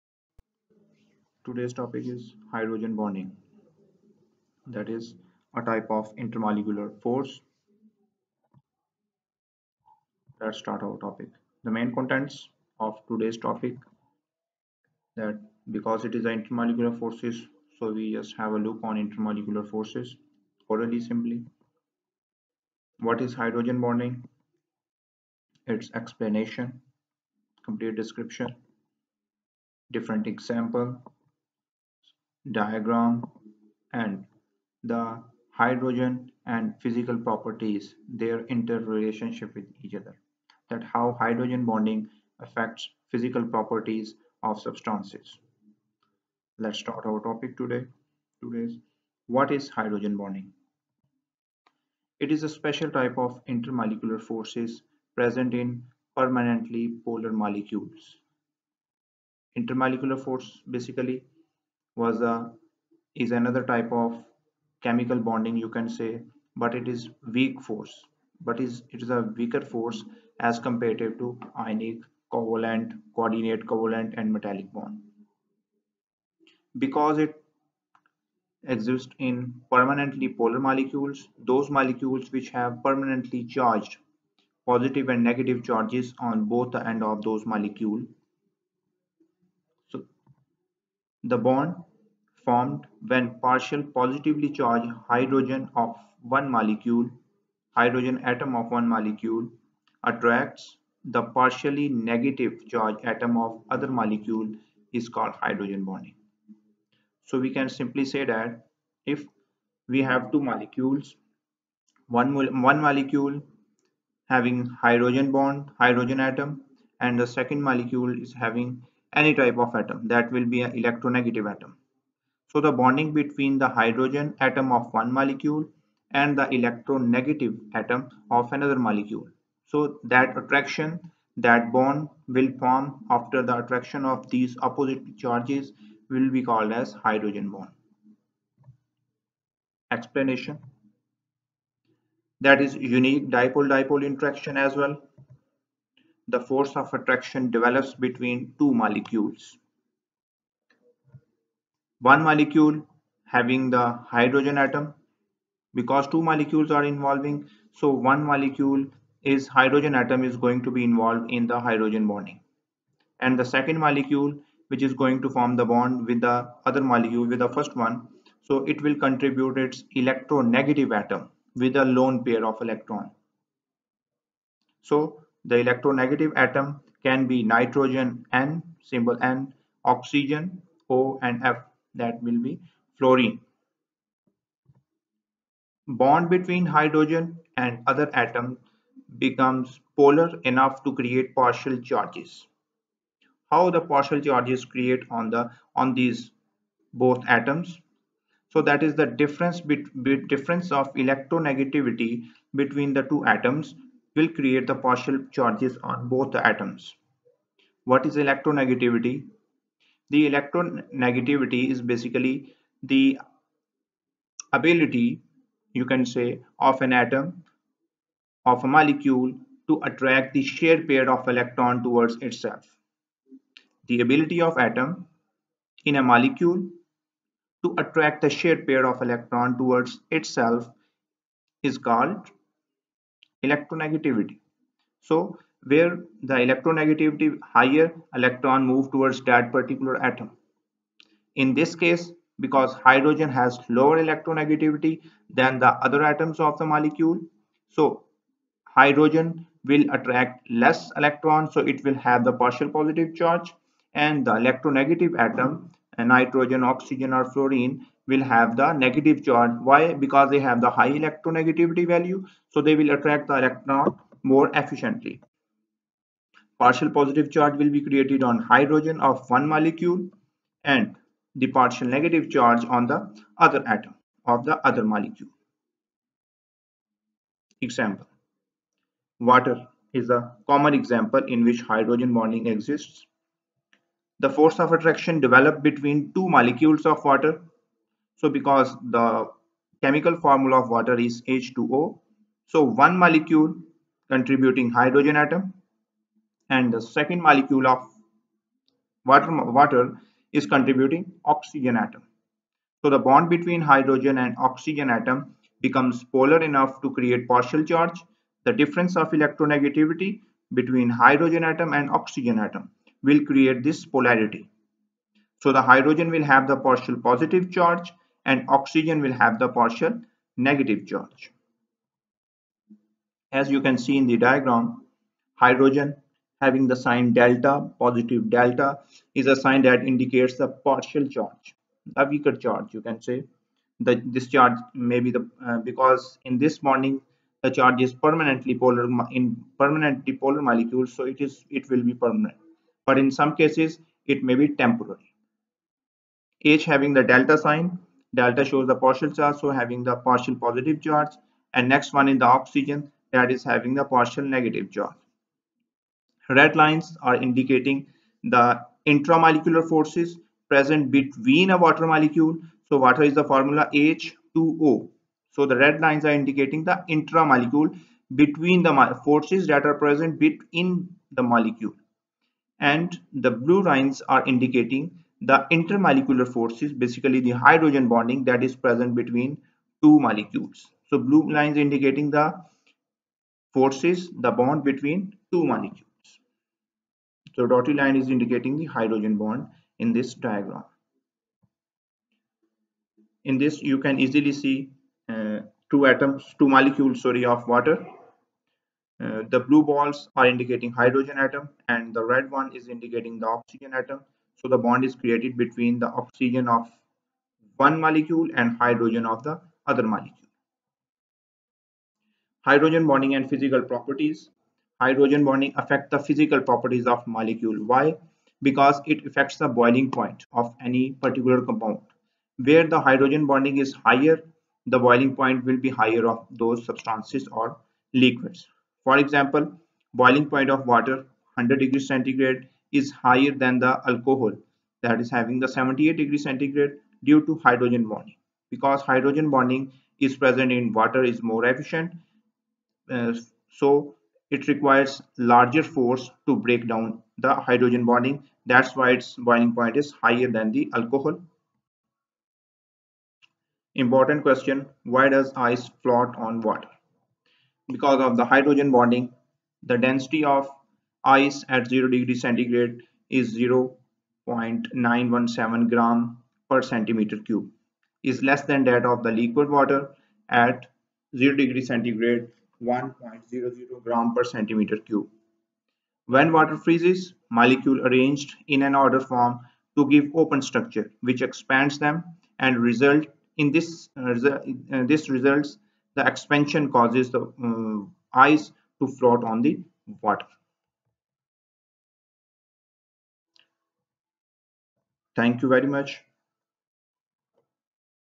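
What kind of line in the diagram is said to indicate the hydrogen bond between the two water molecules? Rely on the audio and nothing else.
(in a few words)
Dotted line.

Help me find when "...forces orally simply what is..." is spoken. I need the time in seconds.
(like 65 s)
19 s.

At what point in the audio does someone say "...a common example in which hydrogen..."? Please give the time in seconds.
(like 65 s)
280 s.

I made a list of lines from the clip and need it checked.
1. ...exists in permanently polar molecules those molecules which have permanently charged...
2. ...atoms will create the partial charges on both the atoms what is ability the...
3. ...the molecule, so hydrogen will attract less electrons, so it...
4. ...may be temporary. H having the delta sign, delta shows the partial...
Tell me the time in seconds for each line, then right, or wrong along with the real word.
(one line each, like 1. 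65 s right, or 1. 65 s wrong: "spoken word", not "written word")
1. 78 s right
2. 203 s wrong: "electronegativity", not "ability"
3. 246 s right
4. 344 s right.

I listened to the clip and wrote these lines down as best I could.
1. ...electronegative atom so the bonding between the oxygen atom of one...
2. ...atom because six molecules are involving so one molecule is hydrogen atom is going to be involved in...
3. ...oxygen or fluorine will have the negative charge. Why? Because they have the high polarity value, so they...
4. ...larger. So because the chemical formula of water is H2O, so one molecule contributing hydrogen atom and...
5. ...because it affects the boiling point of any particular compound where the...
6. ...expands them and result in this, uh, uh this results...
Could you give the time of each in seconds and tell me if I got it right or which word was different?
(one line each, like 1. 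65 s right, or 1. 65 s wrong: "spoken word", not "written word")
1. 120 s wrong: "hydrogen", not "oxygen"
2. 154 s wrong: "two", not "six"
3. 256 s wrong: "electronegativity", not "polarity"
4. 287 s wrong: "water", not "larger"
5. 418 s right
6. 481 s right.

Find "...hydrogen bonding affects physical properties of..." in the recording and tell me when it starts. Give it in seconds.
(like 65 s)
41 s.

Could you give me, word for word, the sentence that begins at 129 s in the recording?
So that attraction, that bond will form after the attraction of these opposite charges will be called as hydrogen bond.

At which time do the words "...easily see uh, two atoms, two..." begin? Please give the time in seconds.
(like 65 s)
393 s.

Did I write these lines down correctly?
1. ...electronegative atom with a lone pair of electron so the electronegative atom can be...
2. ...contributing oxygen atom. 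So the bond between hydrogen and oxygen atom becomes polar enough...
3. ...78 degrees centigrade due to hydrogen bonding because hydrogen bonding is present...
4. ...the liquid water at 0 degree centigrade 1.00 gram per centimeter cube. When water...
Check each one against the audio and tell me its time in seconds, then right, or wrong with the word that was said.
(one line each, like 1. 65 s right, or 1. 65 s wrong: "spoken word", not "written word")
1. 169 s right
2. 300 s right
3. 435 s right
4. 469 s right.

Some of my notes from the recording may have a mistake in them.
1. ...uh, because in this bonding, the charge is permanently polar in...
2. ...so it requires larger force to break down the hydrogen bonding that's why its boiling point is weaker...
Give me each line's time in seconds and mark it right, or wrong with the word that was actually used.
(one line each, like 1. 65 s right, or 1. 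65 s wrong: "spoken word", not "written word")
1. 335 s right
2. 443 s wrong: "higher", not "weaker".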